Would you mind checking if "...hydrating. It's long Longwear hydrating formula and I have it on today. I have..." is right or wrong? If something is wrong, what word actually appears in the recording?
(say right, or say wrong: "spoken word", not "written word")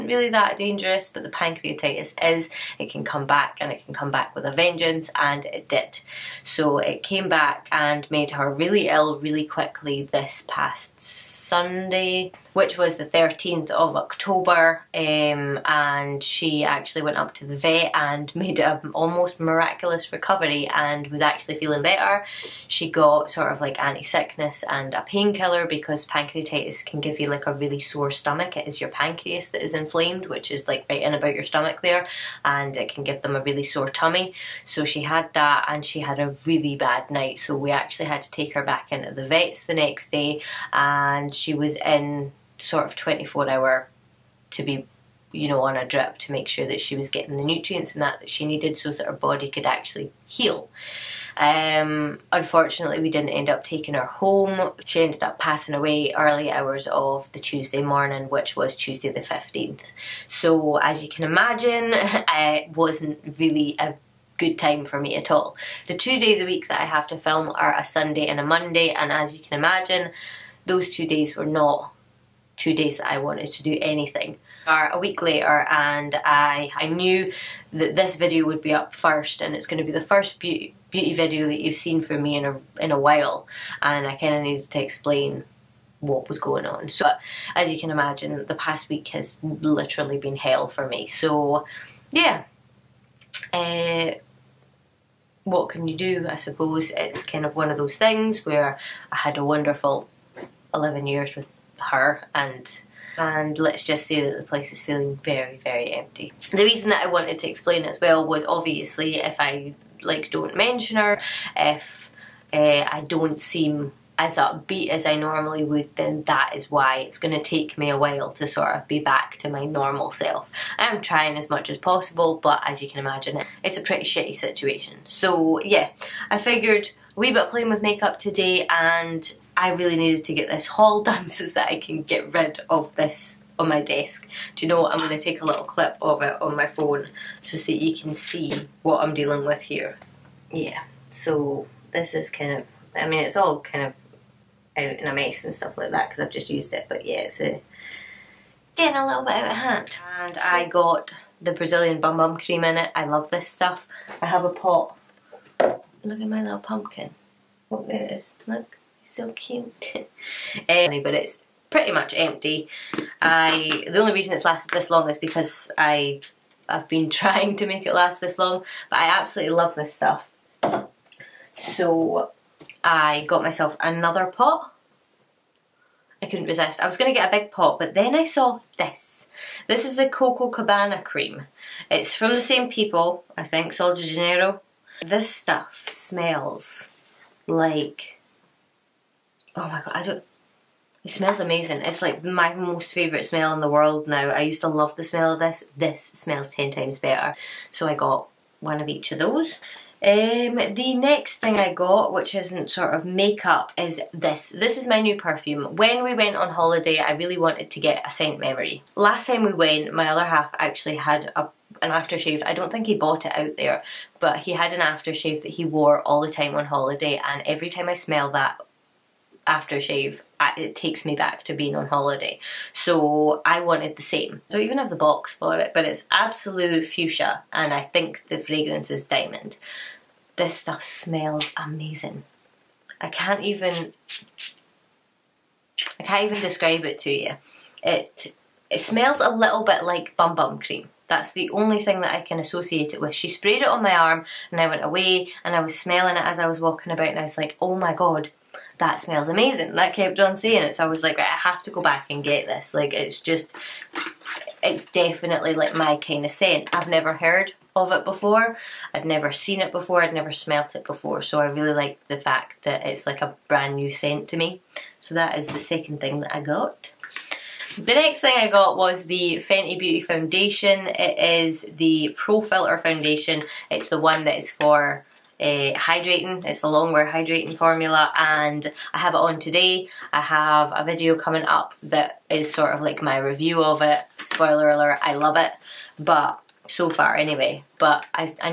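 right.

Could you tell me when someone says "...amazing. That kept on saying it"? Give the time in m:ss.
4:09.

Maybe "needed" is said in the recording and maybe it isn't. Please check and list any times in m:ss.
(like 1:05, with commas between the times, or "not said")
0:48, 1:24, 2:09.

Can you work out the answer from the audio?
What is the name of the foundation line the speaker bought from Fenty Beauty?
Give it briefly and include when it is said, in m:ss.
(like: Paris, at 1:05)
Pro Filter, at 4:32.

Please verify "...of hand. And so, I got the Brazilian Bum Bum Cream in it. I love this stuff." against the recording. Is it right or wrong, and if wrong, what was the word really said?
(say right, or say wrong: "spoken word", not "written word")
right.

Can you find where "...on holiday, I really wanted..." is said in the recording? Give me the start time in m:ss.
3:26.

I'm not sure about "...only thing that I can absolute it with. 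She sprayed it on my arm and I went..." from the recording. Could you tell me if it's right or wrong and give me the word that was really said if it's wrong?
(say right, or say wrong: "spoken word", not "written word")
wrong: "associate", not "absolute".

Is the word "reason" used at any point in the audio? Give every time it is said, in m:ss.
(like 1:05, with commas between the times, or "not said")
1:46, 2:44.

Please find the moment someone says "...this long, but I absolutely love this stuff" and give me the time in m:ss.
2:48.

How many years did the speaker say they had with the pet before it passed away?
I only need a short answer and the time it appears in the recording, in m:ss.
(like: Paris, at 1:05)
11, at 1:40.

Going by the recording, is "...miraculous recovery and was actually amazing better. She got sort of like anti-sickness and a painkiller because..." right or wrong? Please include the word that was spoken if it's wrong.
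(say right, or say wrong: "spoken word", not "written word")
wrong: "feeling", not "amazing".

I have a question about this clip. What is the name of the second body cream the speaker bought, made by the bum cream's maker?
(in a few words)
Coco Cabana.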